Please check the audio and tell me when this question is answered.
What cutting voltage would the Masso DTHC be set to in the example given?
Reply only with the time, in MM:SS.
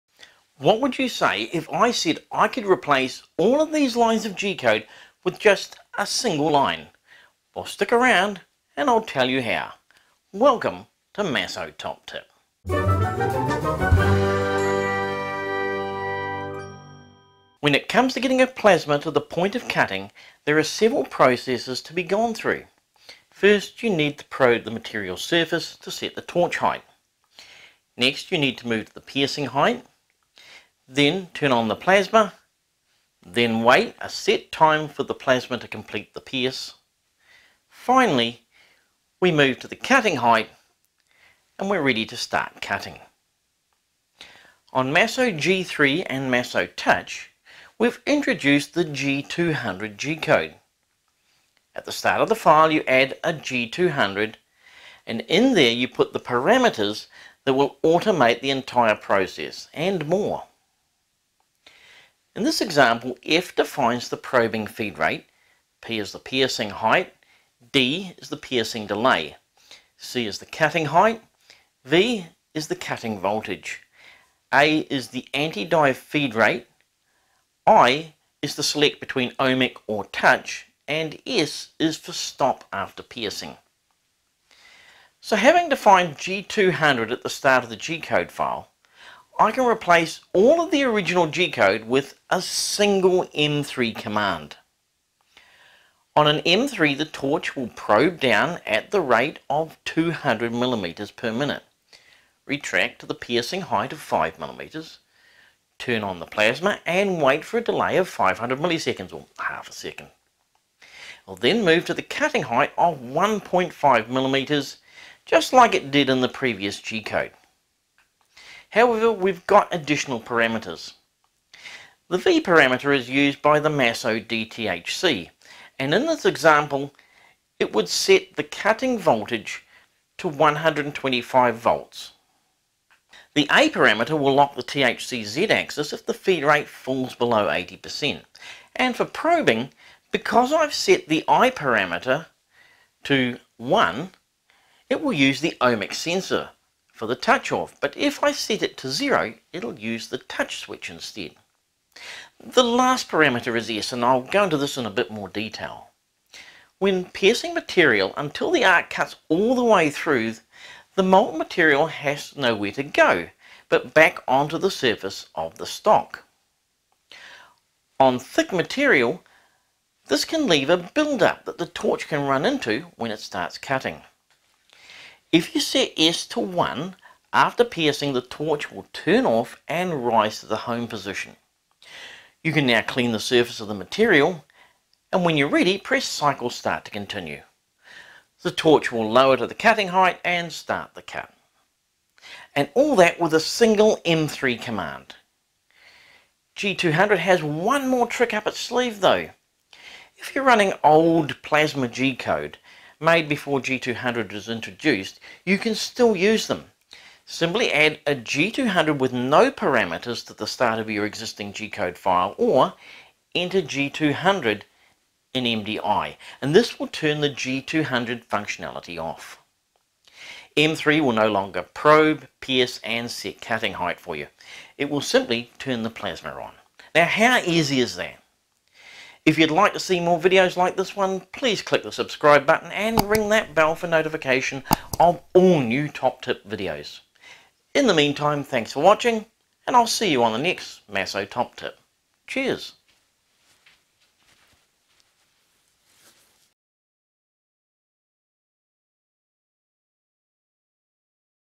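02:10.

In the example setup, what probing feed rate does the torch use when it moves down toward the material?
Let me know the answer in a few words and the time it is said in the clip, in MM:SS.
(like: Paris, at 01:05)
200 millimeters per minute, at 01:39.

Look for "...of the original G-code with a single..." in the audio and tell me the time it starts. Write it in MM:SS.
01:30.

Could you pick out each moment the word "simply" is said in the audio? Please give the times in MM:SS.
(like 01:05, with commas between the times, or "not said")
03:27, 03:45.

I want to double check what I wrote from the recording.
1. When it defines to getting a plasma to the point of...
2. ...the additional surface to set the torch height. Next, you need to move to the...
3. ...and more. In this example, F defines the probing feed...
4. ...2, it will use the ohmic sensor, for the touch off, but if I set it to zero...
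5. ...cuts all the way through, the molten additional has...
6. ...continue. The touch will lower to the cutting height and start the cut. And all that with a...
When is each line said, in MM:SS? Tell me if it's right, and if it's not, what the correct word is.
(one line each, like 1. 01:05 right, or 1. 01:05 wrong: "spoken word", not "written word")
1. 00:17 wrong: "comes", not "defines"
2. 00:24 wrong: "material", not "additional"
3. 00:59 right
4. 02:23 wrong: "1", not "2"
5. 02:38 wrong: "material", not "additional"
6. 03:06 wrong: "torch", not "touch".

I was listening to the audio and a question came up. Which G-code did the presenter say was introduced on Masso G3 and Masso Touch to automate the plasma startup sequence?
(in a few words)
G200.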